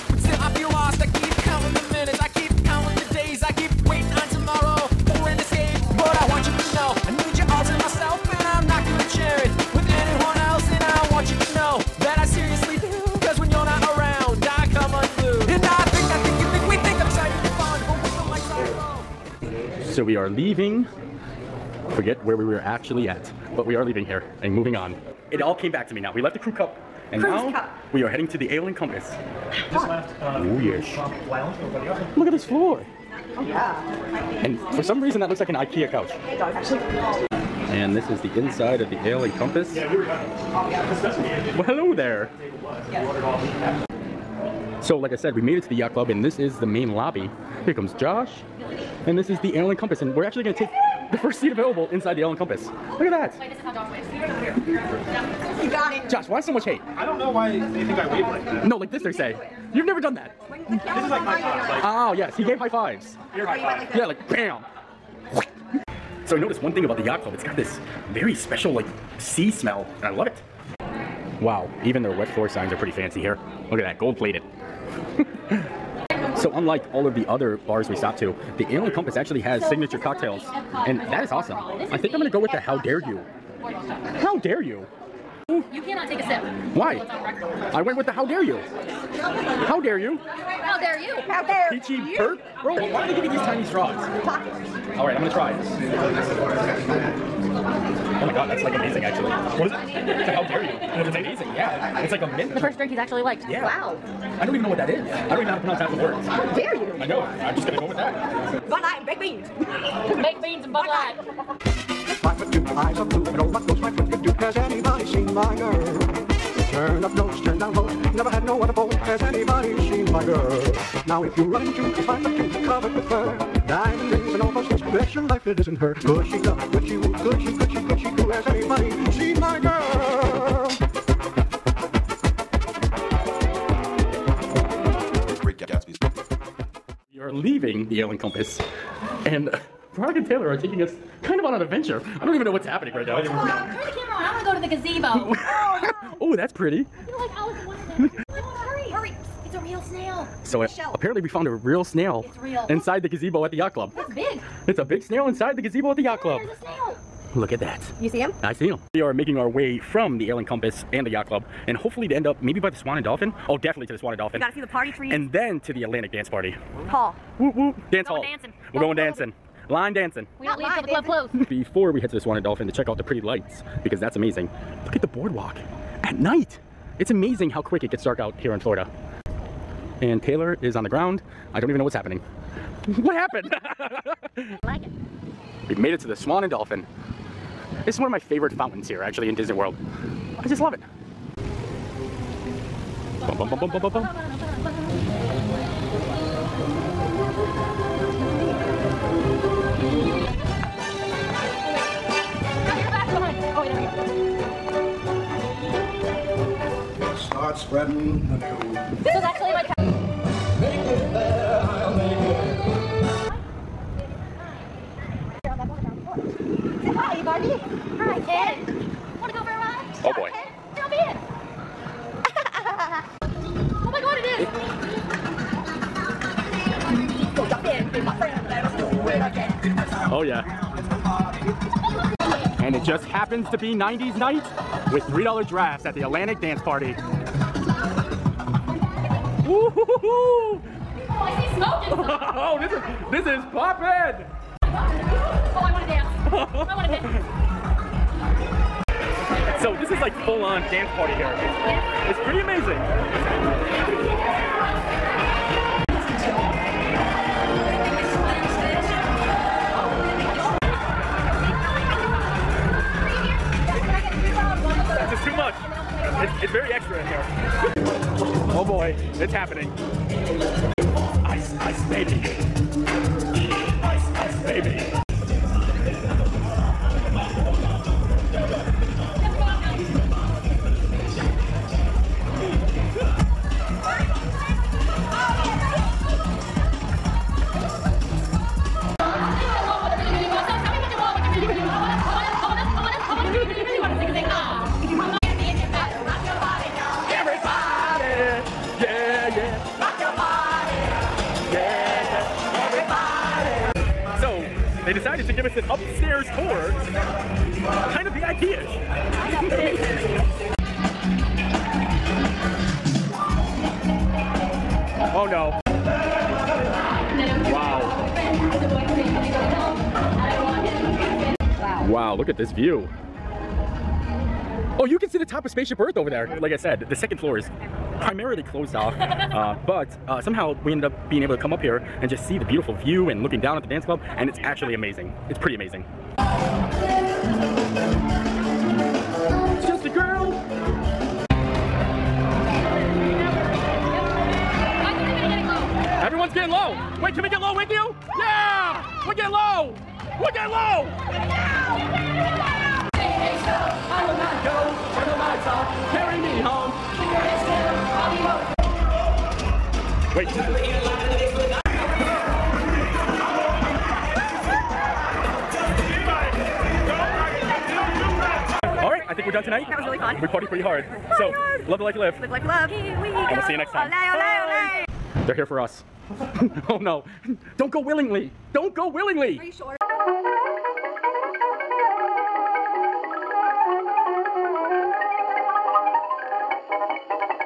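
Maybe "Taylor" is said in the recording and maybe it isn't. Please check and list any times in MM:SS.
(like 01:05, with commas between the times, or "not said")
02:20, 03:00.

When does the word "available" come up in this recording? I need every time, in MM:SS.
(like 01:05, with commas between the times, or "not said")
00:51.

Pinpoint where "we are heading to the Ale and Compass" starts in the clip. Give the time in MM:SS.
00:27.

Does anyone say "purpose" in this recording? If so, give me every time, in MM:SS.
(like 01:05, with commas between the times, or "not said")
not said.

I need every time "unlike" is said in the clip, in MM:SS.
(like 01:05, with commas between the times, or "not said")
01:16.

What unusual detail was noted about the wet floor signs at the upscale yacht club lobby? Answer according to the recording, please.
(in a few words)
Gold plated.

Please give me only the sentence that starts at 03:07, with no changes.
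This is one of my favorite fountains here, actually, in Disney World.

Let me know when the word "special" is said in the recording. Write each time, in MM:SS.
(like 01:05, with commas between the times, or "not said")
01:08.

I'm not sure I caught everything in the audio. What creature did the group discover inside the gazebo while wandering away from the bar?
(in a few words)
A snail.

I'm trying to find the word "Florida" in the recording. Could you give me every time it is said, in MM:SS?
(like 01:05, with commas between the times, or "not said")
02:58.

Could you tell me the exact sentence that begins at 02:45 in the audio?
And then to the Atlantic Dance Party.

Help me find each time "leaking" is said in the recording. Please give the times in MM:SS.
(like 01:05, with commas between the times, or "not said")
not said.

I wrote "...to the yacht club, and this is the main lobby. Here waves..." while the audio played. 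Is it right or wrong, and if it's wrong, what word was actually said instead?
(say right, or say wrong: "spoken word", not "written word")
wrong: "comes", not "waves".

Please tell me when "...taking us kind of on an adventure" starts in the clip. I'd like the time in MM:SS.
02:20.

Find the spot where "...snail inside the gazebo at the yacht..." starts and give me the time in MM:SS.
02:35.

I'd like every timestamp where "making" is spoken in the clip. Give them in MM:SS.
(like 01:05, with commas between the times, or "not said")
02:39.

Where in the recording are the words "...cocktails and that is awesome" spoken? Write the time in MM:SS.
01:19.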